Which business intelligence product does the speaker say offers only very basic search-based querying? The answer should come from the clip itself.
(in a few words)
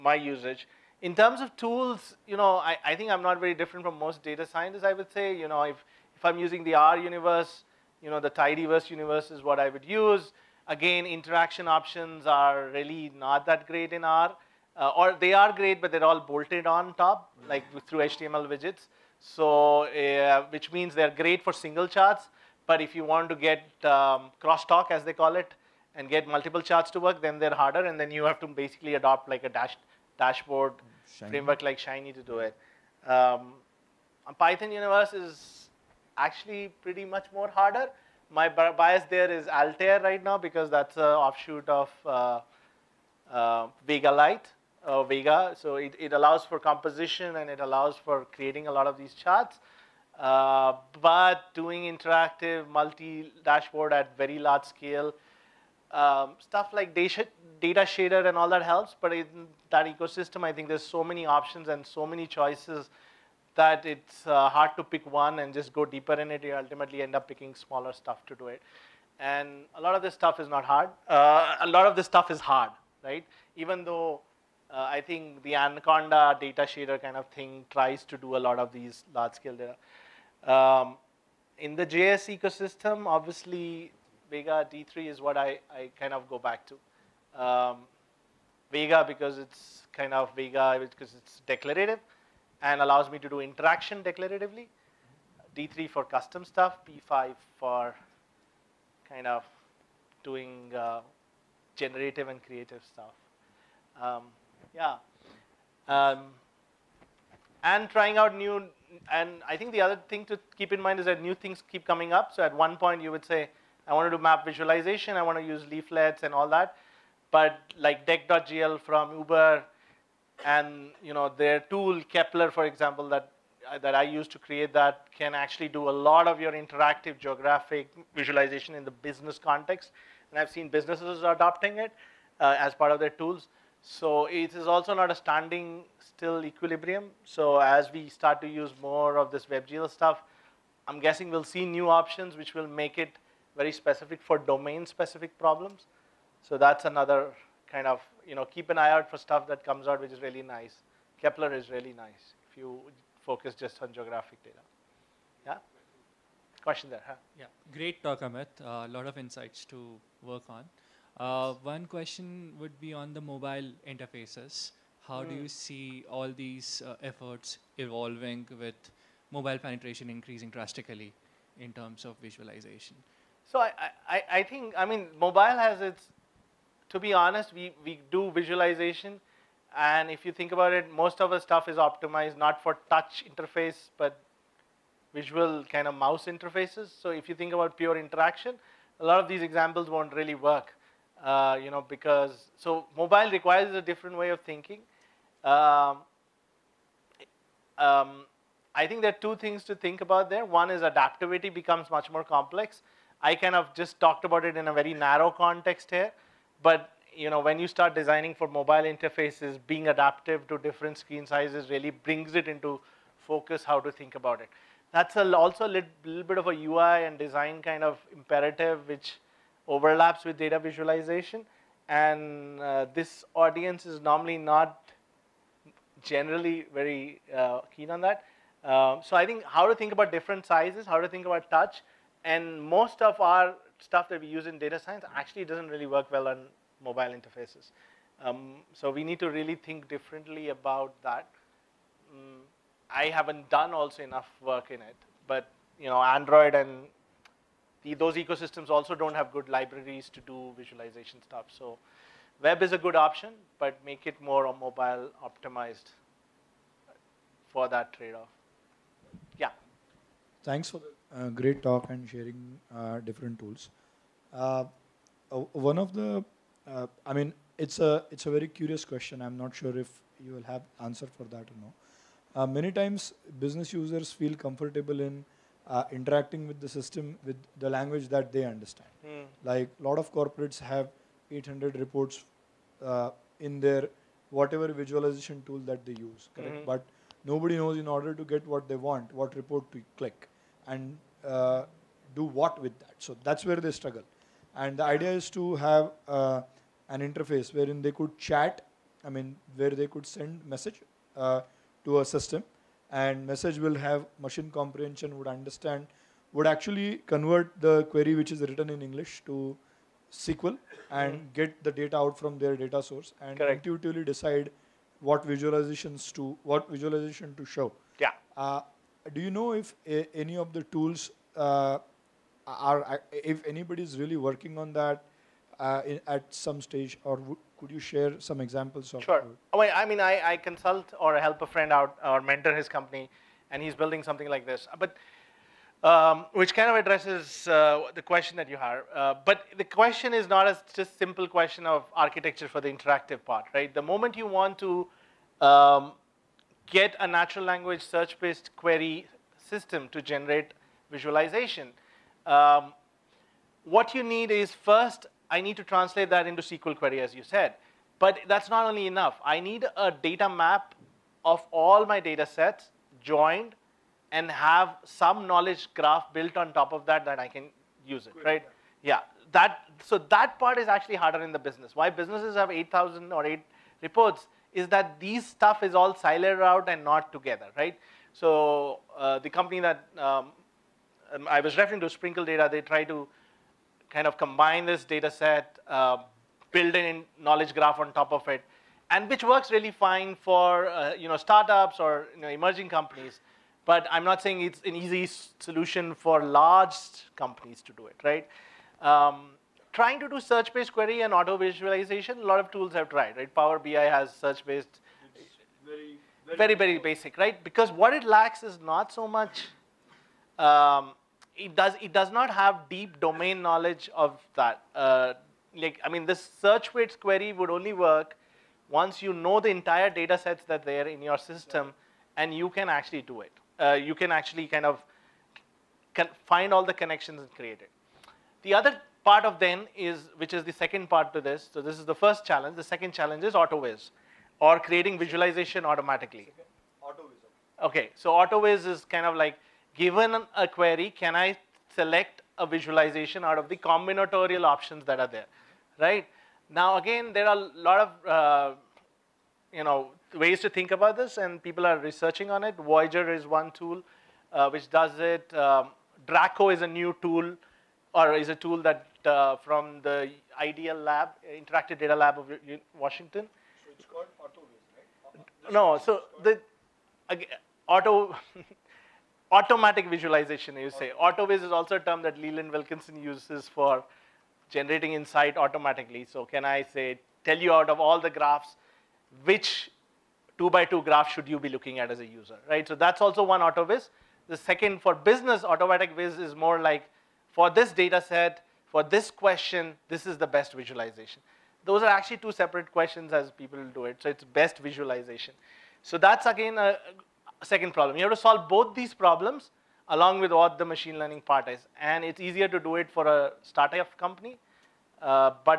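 Power BI.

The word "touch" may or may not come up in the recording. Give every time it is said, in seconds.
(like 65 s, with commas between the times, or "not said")
182 s, 231 s.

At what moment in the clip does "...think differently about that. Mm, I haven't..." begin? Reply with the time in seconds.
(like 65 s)
239 s.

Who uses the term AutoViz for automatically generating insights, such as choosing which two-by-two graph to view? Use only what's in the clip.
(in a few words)
Leland Wilkinson.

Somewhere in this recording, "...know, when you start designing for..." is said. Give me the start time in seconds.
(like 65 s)
207 s.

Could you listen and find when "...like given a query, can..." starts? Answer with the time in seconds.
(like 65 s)
439 s.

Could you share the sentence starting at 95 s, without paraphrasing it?
D3 for custom stuff, P5 for kind of doing uh, generative and creative stuff.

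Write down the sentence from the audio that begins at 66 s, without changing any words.
You ultimately end up picking smaller stuff to do it.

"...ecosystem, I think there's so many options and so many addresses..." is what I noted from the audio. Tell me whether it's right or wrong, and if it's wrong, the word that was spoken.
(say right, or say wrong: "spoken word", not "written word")
wrong: "choices", not "addresses".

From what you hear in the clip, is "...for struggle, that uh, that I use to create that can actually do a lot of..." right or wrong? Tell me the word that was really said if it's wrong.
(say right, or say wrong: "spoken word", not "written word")
wrong: "example", not "struggle".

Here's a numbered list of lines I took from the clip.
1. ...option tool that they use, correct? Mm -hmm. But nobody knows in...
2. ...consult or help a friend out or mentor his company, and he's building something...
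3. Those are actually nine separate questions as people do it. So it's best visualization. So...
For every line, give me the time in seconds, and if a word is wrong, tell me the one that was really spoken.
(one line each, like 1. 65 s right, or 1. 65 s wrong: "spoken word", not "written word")
1. 284 s wrong: "visualization", not "option"
2. 330 s right
3. 491 s wrong: "two", not "nine".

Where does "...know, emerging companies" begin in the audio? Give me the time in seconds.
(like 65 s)
392 s.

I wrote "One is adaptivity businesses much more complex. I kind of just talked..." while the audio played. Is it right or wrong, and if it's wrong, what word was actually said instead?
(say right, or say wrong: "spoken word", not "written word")
wrong: "becomes", not "businesses".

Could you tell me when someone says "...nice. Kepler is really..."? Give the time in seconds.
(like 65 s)
150 s.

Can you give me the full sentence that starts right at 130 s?
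And I've seen businesses adopting it uh, as part of their tools.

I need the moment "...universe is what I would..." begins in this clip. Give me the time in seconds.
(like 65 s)
8 s.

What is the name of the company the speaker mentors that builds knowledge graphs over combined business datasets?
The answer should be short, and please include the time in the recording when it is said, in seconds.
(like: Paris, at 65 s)
Sprinkle Data, at 381 s.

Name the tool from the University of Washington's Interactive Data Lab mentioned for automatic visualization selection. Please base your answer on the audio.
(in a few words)
Draco.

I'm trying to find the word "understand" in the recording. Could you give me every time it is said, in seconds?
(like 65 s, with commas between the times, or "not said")
278 s, 305 s.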